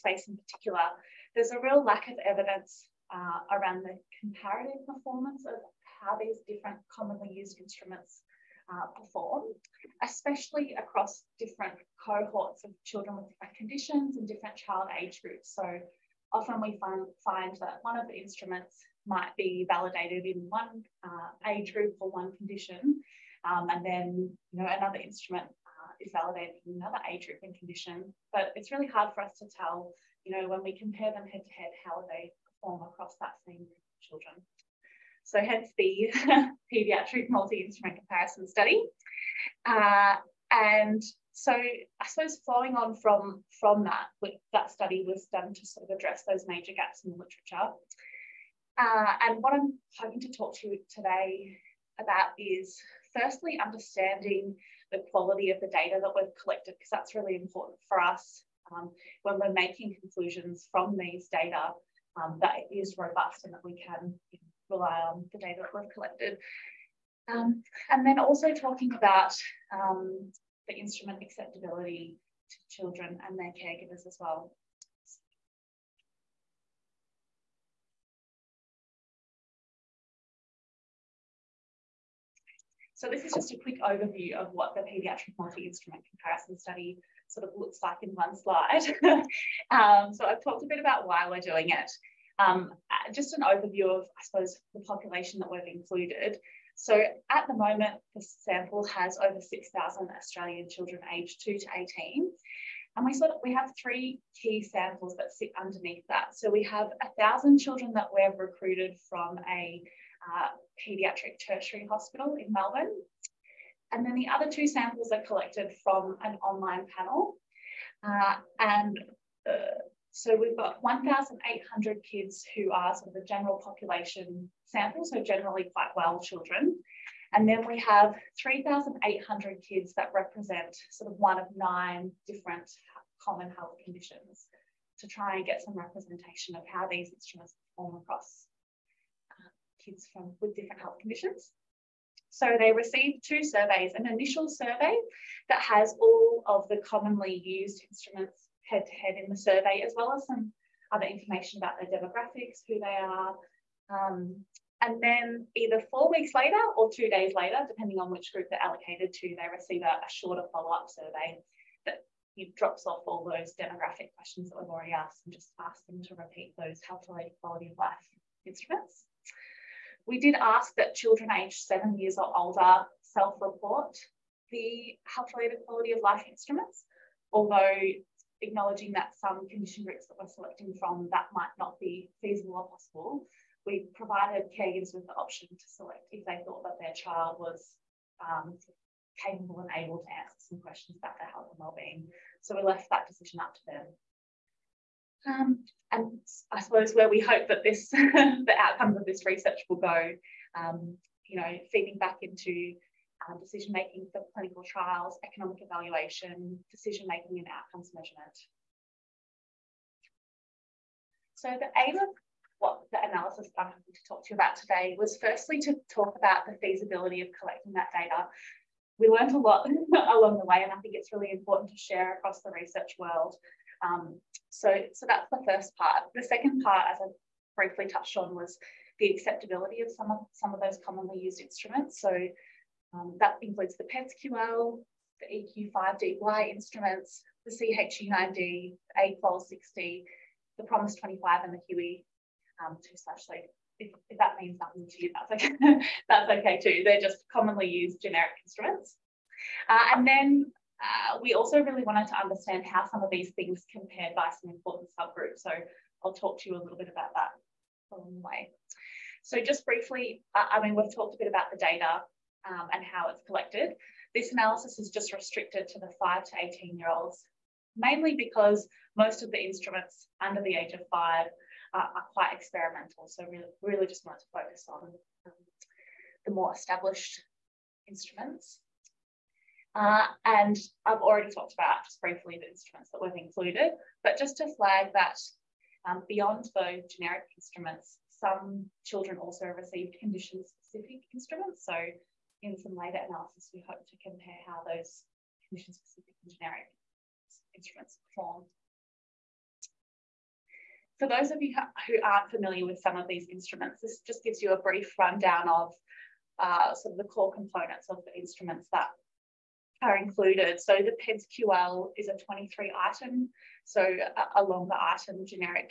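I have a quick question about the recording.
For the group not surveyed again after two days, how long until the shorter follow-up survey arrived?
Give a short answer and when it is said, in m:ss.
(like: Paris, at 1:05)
four weeks, at 2:35.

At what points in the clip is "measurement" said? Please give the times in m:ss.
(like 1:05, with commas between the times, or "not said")
3:27.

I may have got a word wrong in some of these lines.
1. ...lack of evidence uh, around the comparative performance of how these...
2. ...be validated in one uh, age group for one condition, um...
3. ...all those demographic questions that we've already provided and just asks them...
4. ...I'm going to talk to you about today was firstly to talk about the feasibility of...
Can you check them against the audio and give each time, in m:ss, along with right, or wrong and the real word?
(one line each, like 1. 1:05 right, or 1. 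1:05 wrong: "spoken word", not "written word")
1. 0:01 right
2. 0:19 right
3. 2:43 wrong: "asked", not "provided"
4. 3:33 right.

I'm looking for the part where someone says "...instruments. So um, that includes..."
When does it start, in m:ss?
3:51.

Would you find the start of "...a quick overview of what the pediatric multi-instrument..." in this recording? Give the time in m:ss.
1:23.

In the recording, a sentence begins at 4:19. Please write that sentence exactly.
So just briefly, uh, I mean, we've talked a bit about the data um, and how it's collected.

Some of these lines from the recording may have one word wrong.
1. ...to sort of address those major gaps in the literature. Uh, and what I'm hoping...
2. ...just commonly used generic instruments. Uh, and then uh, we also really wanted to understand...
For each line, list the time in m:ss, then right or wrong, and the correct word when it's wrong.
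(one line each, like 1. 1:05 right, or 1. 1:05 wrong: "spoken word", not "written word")
1. 0:45 right
2. 4:07 right.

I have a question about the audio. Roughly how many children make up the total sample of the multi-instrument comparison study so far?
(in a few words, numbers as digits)
over 6,000.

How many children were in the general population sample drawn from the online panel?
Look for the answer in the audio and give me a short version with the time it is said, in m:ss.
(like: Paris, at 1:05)
1,800, at 2:00.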